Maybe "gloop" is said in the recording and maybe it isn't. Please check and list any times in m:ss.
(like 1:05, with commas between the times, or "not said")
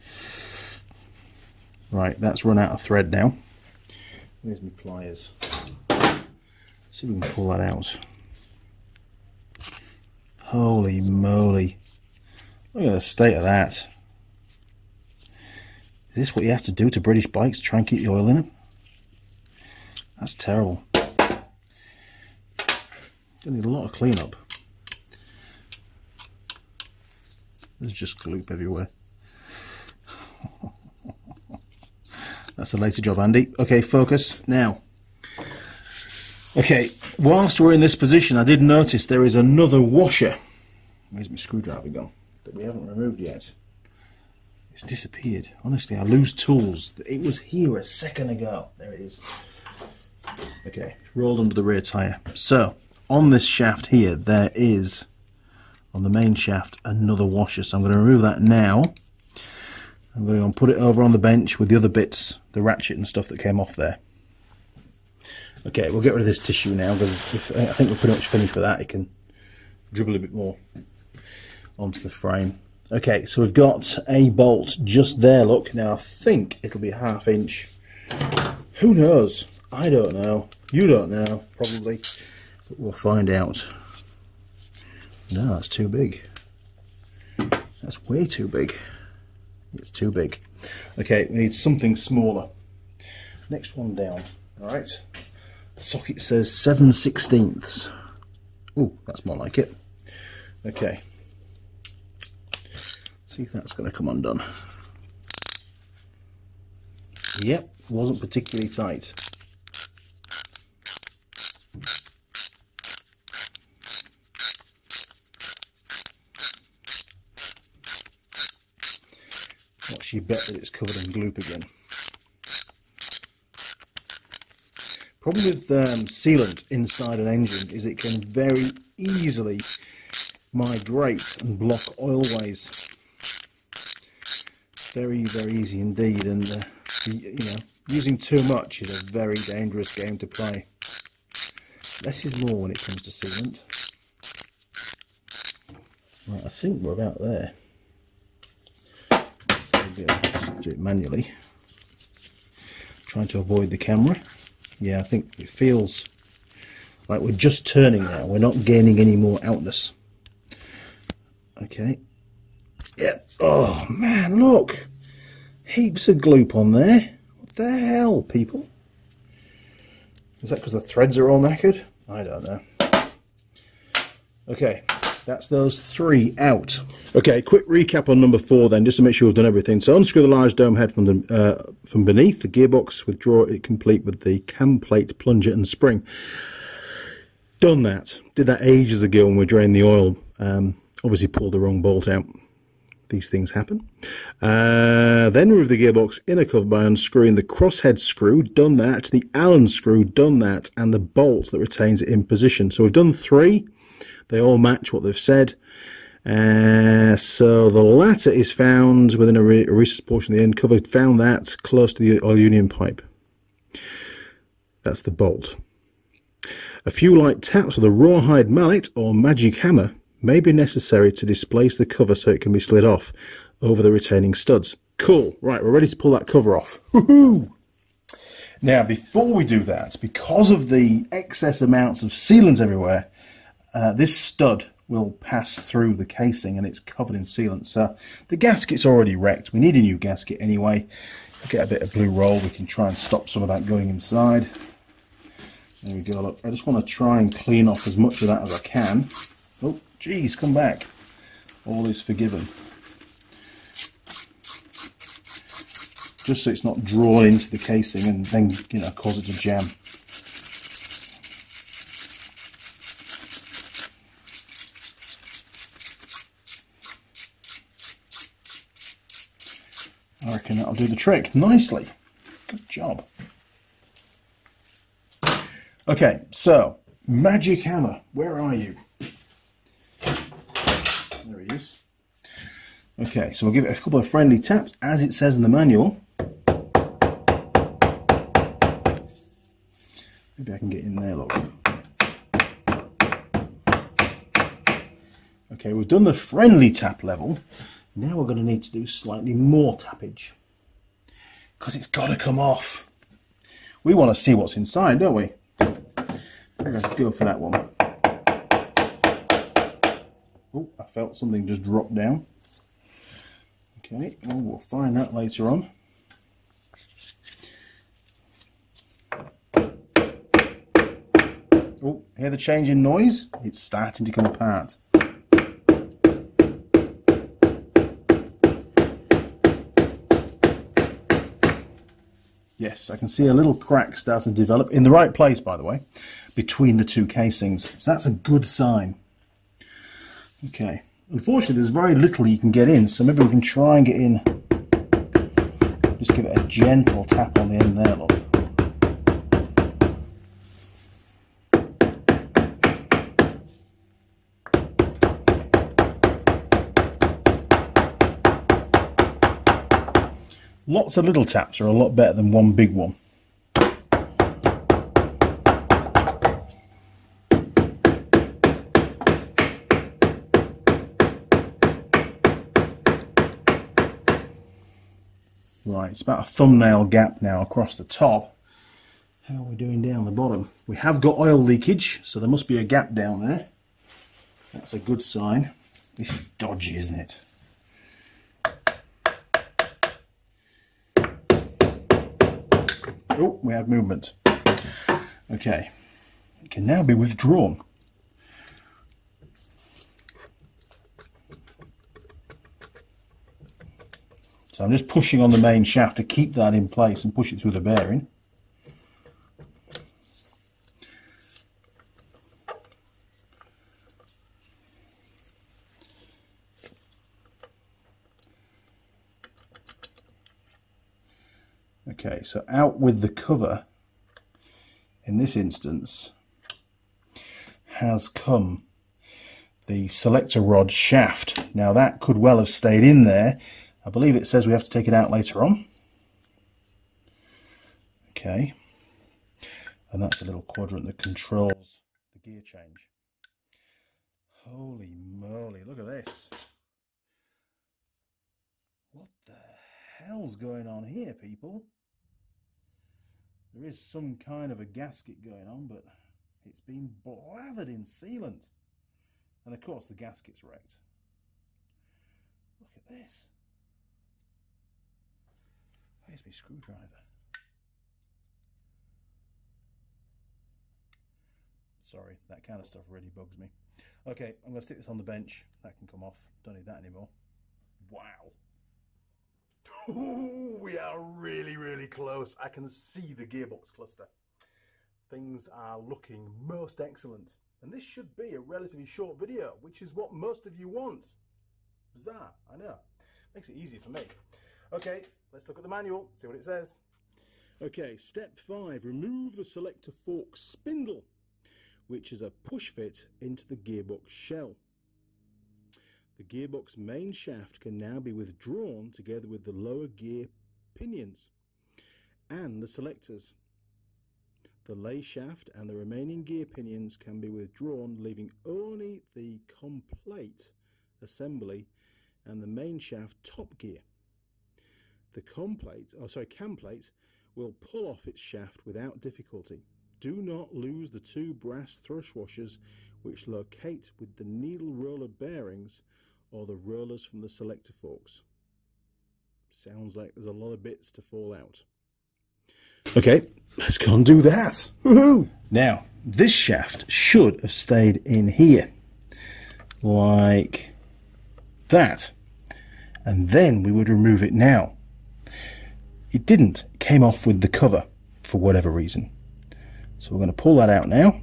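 0:28, 2:01, 2:46.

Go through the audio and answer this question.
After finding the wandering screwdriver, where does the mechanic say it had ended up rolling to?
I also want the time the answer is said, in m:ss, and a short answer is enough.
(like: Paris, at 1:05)
Under the rear tyre, at 0:51.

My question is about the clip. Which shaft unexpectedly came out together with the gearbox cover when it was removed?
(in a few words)
Selector rod shaft.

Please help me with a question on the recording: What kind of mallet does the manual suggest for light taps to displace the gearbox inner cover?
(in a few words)
Rawhide mallet.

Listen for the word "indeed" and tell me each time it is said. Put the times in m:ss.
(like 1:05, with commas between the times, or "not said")
2:15.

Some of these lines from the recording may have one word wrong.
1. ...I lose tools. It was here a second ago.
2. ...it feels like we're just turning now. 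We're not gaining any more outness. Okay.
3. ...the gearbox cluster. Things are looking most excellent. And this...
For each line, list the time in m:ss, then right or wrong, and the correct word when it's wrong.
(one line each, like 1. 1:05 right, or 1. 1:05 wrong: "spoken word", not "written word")
1. 0:45 right
2. 2:35 right
3. 8:03 right.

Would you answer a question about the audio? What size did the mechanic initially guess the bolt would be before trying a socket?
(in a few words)
Half inch.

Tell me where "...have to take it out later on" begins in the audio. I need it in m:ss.
7:14.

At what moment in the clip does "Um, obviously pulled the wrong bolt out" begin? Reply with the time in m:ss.
3:10.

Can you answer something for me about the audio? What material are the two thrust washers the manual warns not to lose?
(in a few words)
Brass.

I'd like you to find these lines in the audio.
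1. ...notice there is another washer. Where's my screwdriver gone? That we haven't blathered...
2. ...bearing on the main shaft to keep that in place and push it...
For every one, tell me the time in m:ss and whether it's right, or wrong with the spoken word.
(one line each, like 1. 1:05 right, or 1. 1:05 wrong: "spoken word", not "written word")
1. 0:38 wrong: "removed", not "blathered"
2. 6:44 wrong: "pushing", not "bearing".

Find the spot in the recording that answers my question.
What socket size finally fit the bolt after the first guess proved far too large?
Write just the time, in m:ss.
1:36.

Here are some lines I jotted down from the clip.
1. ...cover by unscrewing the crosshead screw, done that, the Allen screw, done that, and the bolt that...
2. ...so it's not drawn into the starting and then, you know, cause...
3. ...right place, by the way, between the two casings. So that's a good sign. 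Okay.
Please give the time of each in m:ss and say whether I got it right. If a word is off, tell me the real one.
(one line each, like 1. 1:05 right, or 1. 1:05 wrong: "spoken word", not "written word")
1. 3:16 right
2. 4:16 wrong: "casing", not "starting"
3. 5:34 right.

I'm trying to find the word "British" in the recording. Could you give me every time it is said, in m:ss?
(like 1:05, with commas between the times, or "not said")
0:17.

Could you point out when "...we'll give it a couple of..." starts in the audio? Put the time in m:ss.
4:43.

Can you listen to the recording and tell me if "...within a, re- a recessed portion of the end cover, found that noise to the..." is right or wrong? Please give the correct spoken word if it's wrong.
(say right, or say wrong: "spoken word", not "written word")
wrong: "close", not "noise".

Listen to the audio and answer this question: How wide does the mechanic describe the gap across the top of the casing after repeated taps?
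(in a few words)
A thumbnail gap.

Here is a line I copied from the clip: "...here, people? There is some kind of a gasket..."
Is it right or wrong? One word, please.
right.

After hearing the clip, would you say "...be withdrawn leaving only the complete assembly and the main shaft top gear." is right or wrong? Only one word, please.
right.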